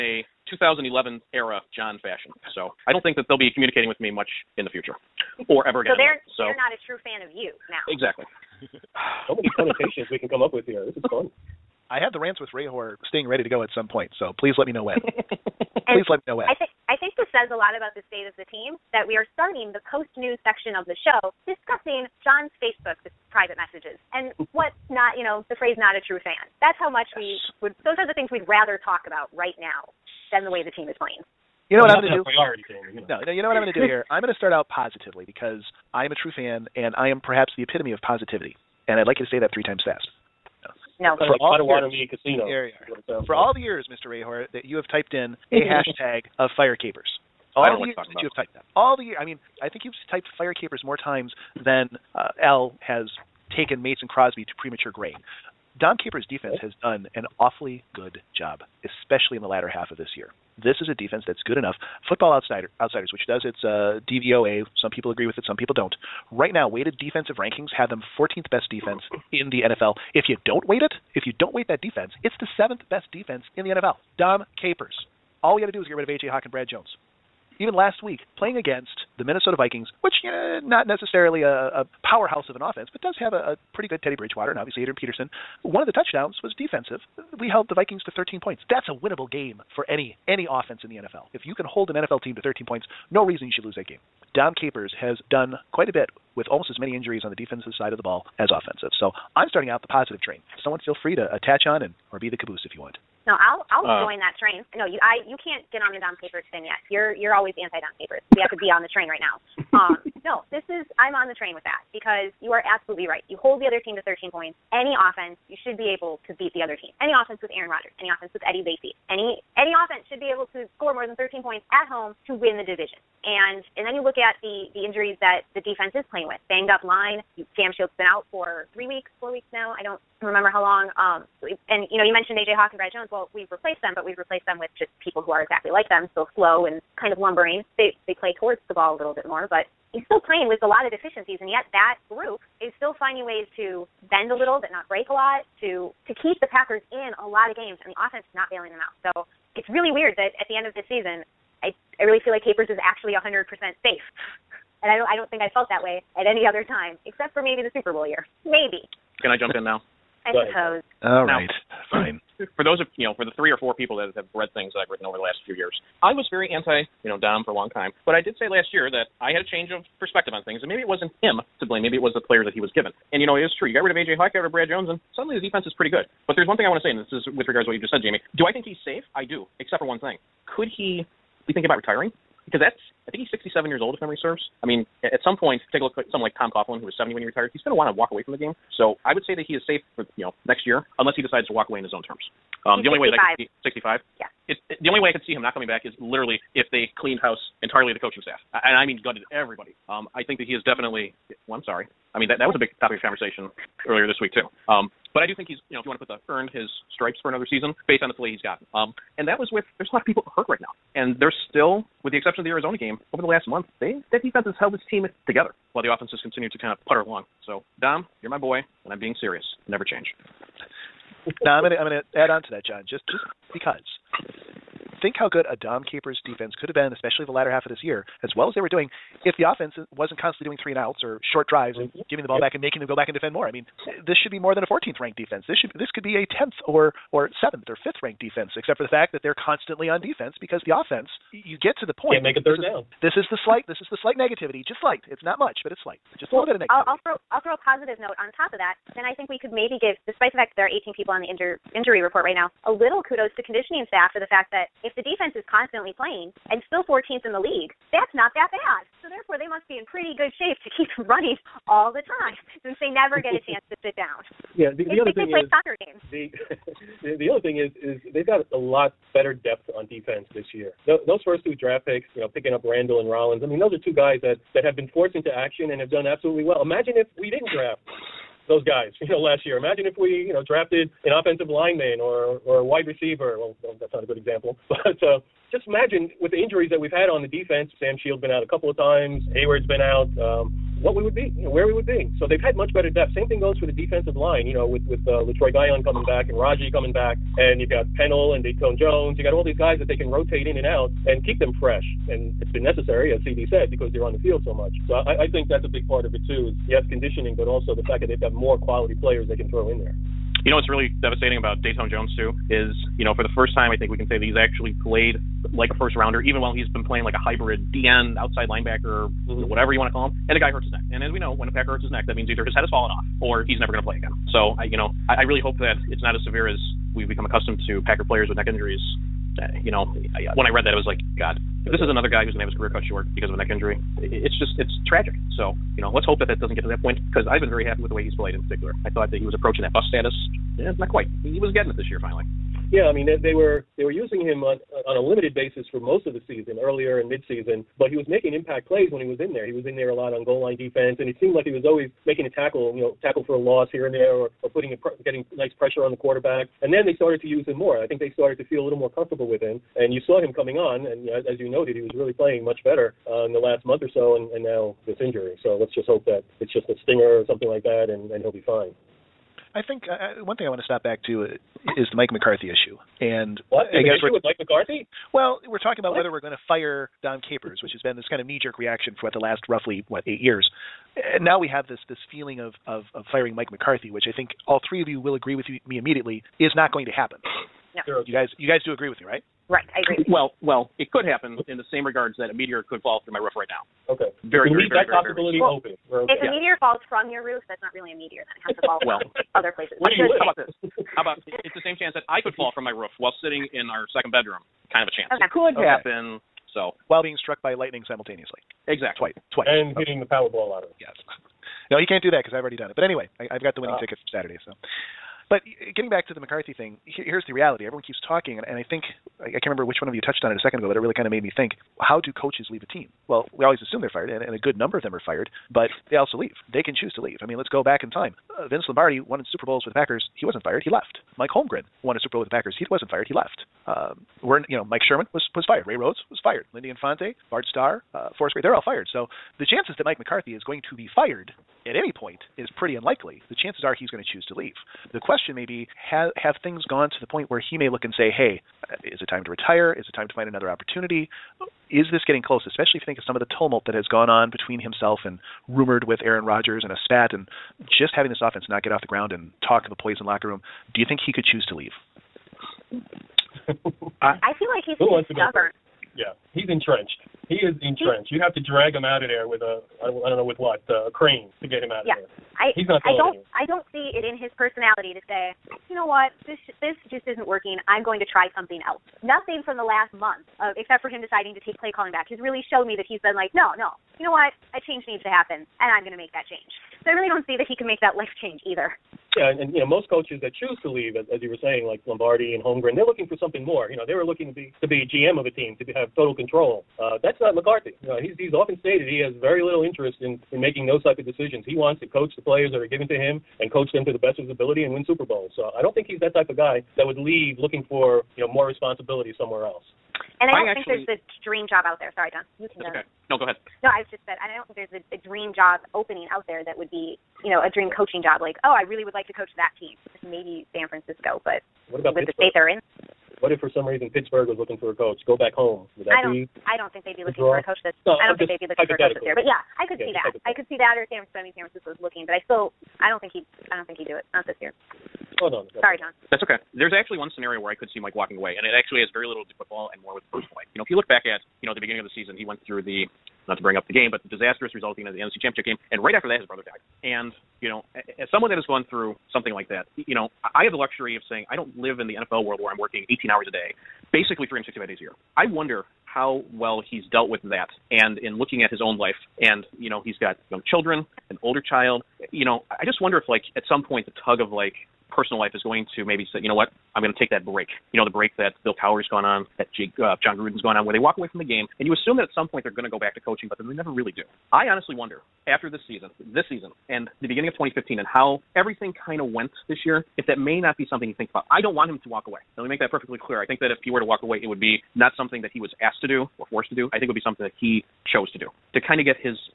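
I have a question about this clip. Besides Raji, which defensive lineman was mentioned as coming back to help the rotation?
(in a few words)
Letroy Guion.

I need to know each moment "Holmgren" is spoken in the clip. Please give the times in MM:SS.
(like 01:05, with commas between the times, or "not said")
07:11, 08:12.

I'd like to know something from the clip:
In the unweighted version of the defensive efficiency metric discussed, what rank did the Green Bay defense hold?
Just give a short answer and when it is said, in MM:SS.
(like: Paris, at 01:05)
7th, at 01:12.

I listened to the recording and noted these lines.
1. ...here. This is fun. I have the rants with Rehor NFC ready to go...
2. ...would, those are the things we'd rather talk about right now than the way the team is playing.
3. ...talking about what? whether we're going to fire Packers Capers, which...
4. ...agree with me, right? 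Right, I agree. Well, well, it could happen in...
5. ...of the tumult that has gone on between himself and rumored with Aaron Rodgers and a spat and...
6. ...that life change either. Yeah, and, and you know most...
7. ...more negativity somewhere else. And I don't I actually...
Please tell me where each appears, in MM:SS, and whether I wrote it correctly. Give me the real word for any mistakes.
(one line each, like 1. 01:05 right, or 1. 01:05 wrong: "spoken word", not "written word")
1. 00:10 wrong: "Sting", not "NFC"
2. 00:27 right
3. 06:15 wrong: "Dom", not "Packers"
4. 06:28 right
5. 07:33 right
6. 08:07 right
7. 08:28 wrong: "responsibility", not "negativity".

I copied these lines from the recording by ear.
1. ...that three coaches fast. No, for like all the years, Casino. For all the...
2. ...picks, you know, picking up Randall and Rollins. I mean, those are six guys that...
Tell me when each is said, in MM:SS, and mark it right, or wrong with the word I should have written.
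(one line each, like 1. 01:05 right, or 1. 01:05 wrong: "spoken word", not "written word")
1. 00:39 wrong: "times", not "coaches"
2. 04:31 wrong: "two", not "six".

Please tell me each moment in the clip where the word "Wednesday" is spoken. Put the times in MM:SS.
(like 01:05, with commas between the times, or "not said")
not said.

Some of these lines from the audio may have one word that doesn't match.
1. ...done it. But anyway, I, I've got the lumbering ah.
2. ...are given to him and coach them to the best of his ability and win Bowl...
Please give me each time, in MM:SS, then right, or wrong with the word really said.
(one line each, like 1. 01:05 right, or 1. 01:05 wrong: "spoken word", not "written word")
1. 06:52 wrong: "winning", not "lumbering"
2. 08:22 wrong: "Super", not "Bowl".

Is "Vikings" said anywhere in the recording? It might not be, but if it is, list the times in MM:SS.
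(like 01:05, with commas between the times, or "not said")
01:19, 01:27.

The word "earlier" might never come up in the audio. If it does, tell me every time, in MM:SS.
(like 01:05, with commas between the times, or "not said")
03:23, 05:46.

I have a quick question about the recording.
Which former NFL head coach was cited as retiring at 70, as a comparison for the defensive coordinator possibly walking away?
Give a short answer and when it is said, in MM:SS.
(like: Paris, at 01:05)
Tom Coughlin, at 03:06.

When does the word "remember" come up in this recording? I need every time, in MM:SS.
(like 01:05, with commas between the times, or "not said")
02:10, 06:59.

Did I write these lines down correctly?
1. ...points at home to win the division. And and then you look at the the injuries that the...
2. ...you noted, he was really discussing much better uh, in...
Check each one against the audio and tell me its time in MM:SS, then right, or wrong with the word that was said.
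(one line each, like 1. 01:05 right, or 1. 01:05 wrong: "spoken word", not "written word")
1. 02:01 right
2. 06:01 wrong: "playing", not "discussing".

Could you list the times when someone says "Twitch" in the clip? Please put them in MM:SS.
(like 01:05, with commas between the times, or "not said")
not said.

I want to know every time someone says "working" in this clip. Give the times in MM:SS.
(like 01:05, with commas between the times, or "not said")
07:57, 09:12.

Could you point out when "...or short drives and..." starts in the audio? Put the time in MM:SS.
03:51.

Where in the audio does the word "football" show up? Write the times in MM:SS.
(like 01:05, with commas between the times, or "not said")
01:02, 08:59.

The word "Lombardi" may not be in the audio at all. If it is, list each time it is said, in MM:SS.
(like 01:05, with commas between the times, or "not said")
07:08, 08:11.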